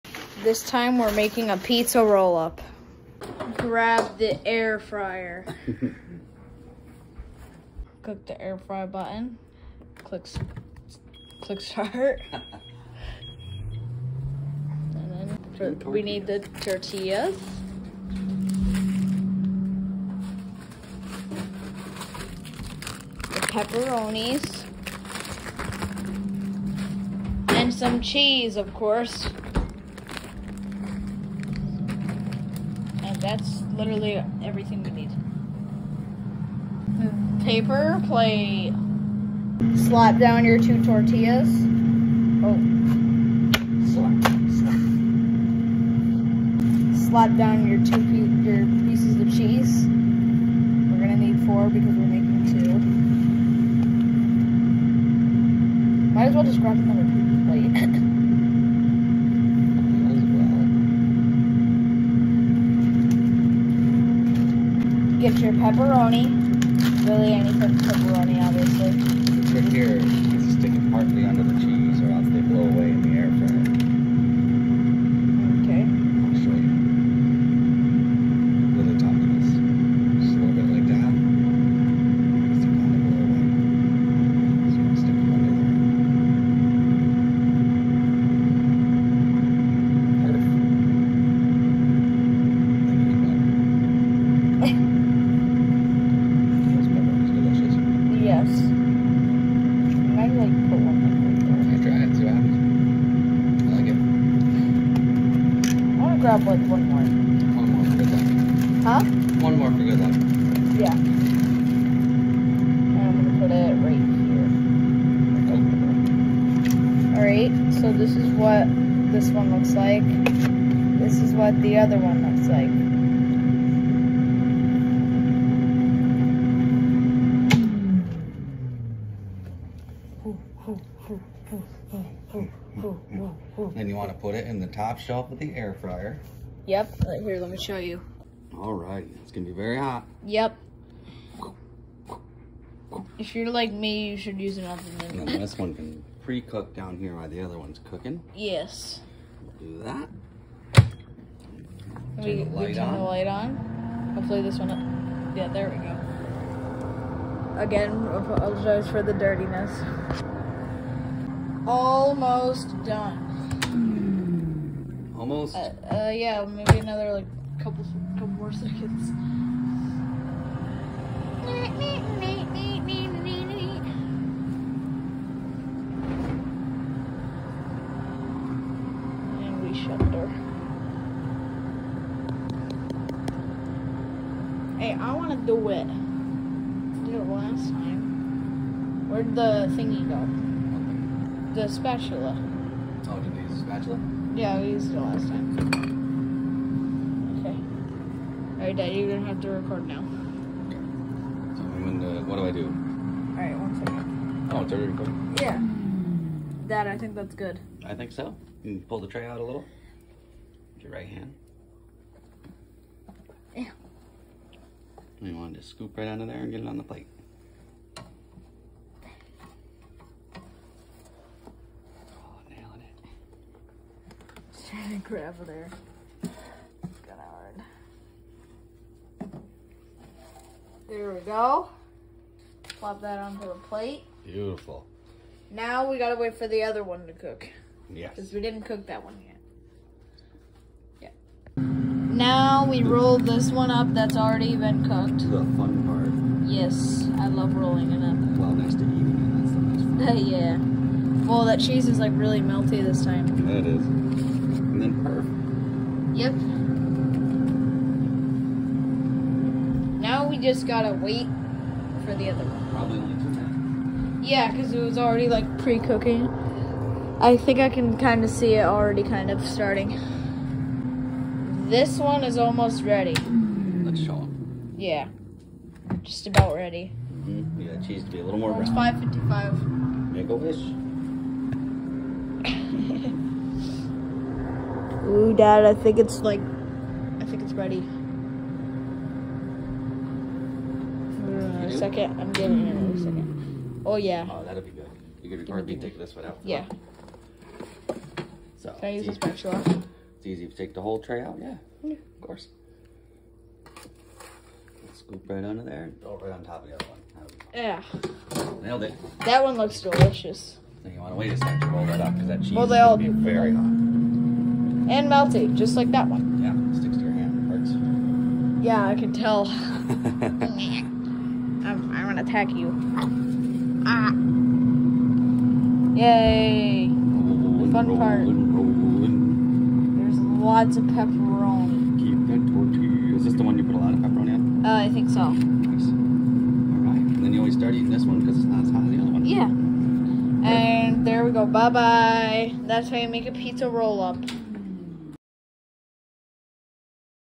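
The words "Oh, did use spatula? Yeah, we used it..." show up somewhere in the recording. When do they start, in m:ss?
3:13.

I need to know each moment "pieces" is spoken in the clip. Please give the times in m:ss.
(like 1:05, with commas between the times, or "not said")
0:48.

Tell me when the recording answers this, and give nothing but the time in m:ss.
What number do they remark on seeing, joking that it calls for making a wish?
4:38.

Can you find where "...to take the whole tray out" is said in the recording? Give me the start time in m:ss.
5:00.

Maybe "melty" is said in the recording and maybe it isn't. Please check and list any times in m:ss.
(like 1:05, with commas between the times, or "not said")
4:12, 5:15.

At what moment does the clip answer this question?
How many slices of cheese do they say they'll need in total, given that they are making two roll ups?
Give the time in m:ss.
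0:51.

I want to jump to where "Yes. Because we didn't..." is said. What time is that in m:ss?
3:57.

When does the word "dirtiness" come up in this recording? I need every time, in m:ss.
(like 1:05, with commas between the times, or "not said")
2:39.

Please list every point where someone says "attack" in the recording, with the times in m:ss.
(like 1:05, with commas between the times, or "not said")
5:22.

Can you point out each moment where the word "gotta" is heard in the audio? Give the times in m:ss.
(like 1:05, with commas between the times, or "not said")
3:55, 4:20.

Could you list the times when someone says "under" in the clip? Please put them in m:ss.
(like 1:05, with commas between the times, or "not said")
1:11, 3:36, 5:05.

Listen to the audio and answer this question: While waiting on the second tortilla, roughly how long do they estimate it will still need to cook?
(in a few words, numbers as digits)
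2 minutes.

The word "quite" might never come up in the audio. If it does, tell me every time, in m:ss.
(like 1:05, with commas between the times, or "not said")
not said.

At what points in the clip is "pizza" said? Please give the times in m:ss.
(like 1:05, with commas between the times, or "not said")
0:01, 5:43.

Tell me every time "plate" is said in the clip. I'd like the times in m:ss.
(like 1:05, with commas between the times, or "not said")
0:38, 0:57, 3:36, 3:53.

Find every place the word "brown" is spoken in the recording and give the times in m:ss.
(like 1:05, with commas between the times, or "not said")
4:38.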